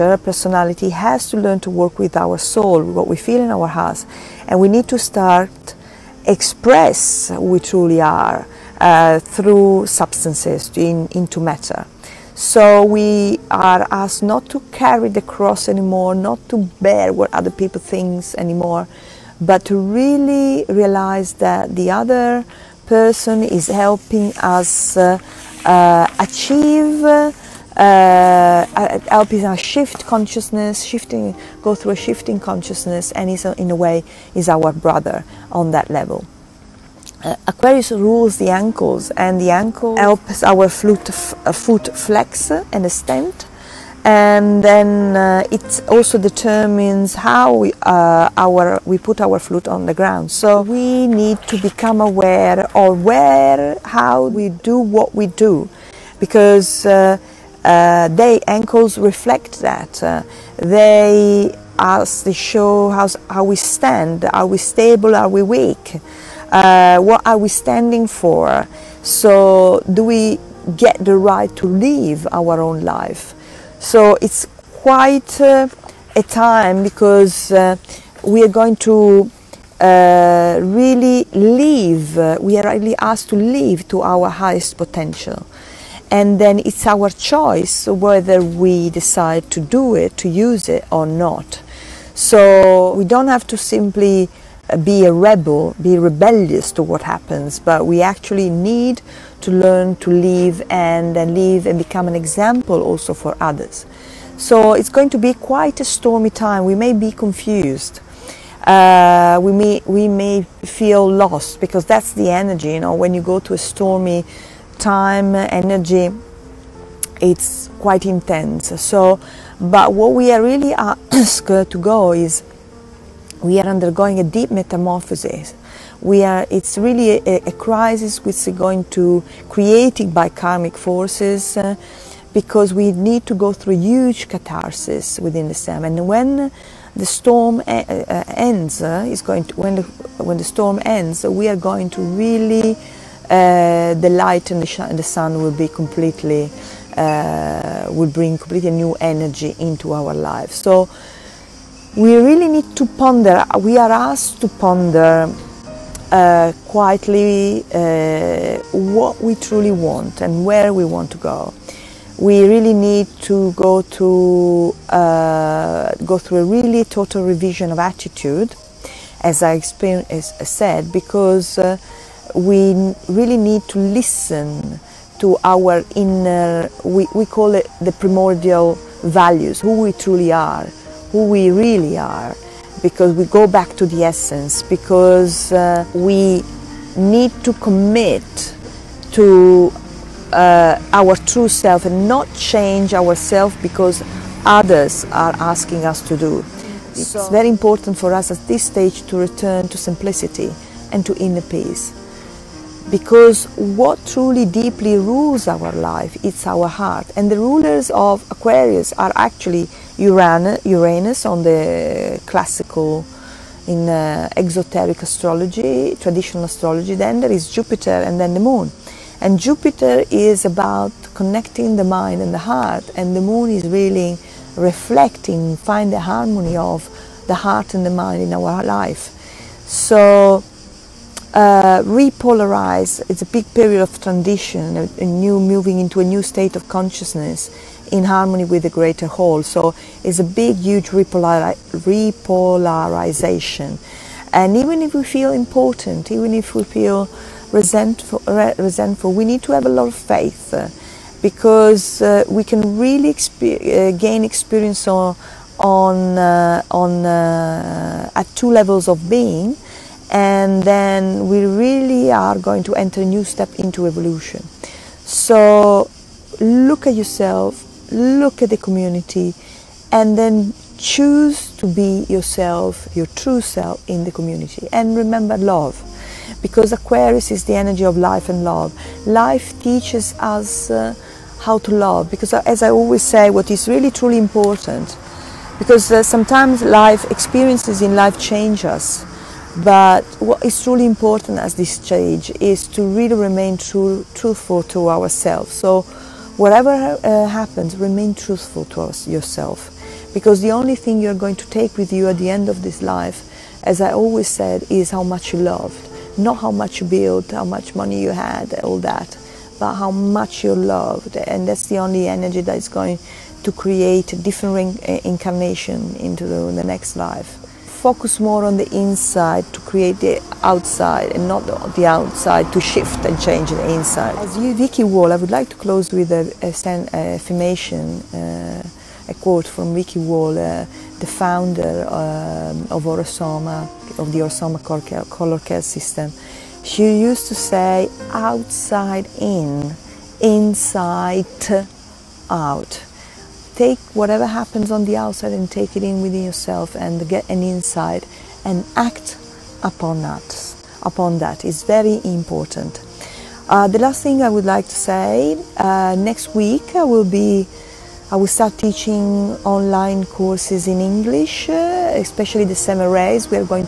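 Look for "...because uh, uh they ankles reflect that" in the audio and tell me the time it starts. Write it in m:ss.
0:56.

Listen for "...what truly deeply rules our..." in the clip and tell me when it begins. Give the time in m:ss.
3:23.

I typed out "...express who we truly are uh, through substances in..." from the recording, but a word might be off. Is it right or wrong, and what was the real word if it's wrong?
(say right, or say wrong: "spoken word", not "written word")
right.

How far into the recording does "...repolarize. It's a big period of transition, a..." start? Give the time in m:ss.
3:51.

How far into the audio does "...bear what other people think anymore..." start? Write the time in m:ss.
0:16.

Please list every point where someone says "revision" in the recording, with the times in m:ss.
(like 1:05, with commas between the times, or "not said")
2:47.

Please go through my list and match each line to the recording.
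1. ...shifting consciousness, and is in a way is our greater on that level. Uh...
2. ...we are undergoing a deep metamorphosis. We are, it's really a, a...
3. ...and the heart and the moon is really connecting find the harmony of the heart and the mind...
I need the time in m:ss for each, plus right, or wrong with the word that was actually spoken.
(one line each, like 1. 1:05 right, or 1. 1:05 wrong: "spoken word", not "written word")
1. 0:31 wrong: "brother", not "greater"
2. 2:03 right
3. 3:42 wrong: "reflecting", not "connecting".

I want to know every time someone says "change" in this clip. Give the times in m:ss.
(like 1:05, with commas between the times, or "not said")
3:12, 4:48, 5:23.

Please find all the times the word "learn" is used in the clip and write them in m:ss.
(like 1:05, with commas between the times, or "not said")
0:01, 1:39.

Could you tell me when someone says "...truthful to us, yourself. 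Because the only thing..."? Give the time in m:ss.
4:58.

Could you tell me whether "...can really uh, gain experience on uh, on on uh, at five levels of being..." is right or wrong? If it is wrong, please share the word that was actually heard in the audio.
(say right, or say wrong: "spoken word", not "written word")
wrong: "two", not "five".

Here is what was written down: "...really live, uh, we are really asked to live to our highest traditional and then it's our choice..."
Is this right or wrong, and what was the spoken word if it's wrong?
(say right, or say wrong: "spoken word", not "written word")
wrong: "potential", not "traditional".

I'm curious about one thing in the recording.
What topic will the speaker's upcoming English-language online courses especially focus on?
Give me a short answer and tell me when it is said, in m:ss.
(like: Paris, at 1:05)
The seven rays, at 6:02.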